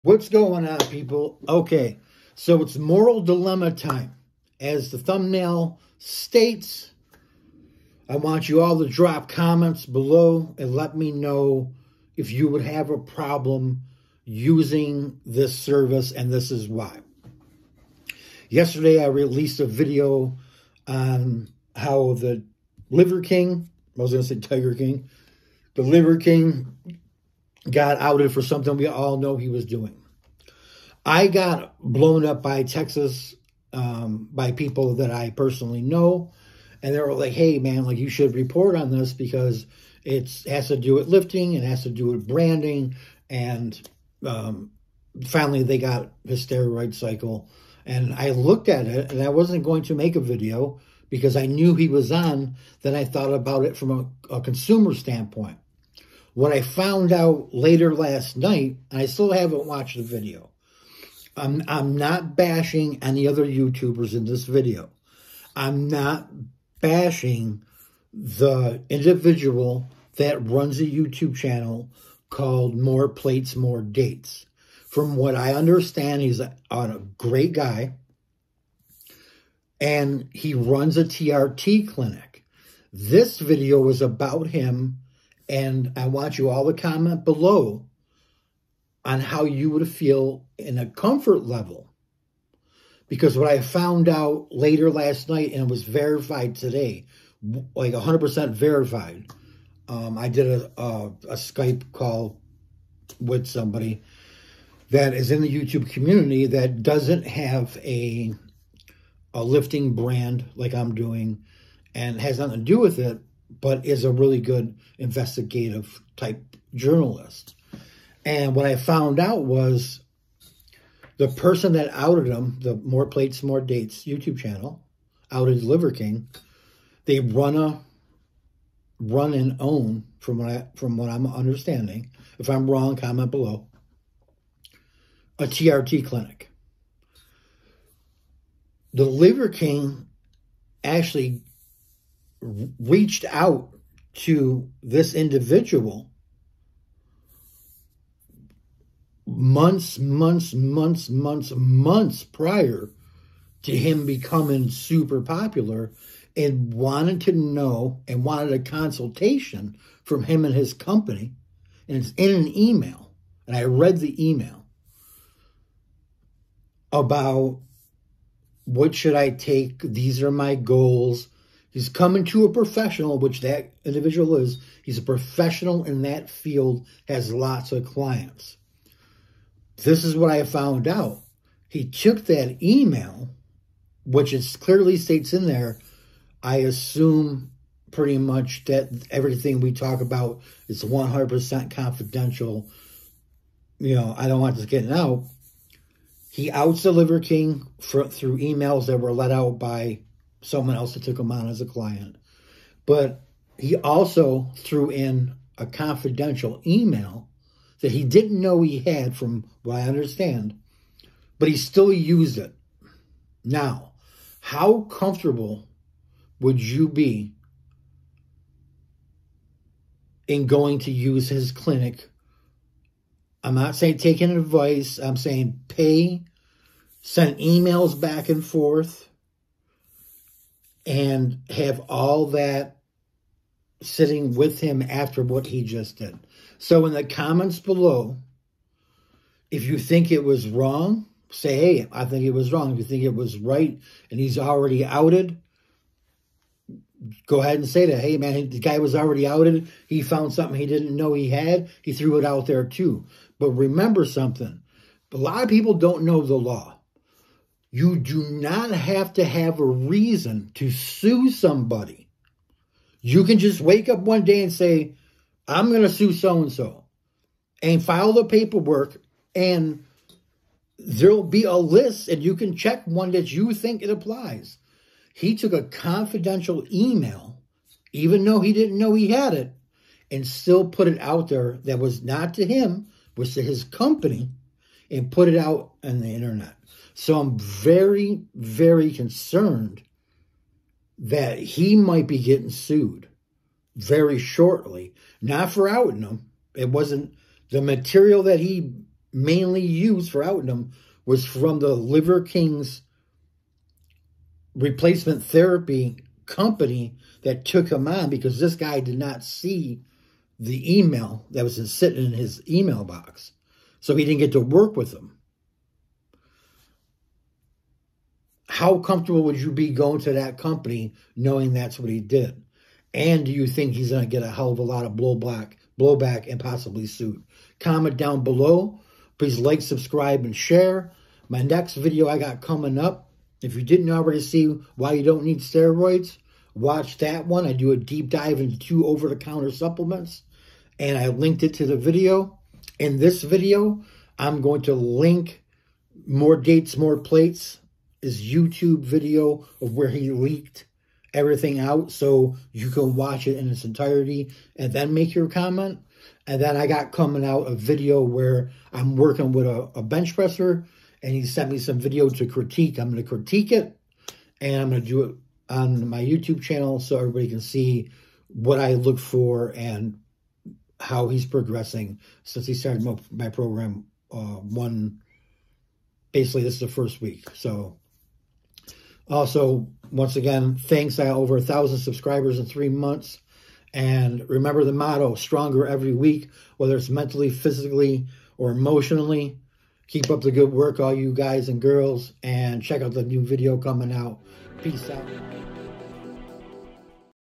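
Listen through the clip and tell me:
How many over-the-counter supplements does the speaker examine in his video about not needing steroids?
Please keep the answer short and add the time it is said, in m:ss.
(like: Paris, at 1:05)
2, at 5:38.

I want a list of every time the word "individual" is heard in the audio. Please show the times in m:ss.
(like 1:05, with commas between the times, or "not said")
1:08, 2:25, 2:53.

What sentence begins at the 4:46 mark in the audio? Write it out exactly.
So I'm very, very concerned that he might be getting sued very shortly.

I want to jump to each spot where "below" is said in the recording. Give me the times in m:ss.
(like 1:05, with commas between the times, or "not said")
0:09, 1:27, 2:13, 3:57, 5:28.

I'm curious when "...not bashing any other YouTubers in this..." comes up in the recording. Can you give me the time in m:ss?
1:01.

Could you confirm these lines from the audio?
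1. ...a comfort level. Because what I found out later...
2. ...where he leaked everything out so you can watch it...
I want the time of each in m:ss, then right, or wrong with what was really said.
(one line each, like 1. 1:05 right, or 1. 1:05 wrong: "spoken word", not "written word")
1. 1:30 right
2. 5:49 right.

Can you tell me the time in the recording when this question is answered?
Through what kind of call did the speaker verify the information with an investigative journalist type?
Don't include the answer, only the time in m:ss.
1:41.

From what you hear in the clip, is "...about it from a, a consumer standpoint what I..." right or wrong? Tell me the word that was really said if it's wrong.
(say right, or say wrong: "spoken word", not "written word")
right.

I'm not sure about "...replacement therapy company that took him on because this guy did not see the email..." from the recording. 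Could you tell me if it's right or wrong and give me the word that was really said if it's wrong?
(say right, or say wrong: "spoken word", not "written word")
right.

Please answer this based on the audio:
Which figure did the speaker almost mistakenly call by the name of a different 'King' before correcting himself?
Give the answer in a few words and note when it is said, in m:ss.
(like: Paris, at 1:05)
Tiger King, at 0:24.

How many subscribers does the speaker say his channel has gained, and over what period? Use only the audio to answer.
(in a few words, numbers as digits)
over 1,000 in three months.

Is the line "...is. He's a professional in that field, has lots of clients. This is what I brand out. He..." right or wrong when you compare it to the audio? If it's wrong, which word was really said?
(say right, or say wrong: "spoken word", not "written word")
wrong: "found", not "brand".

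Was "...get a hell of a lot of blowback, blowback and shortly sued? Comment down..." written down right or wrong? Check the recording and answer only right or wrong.
wrong.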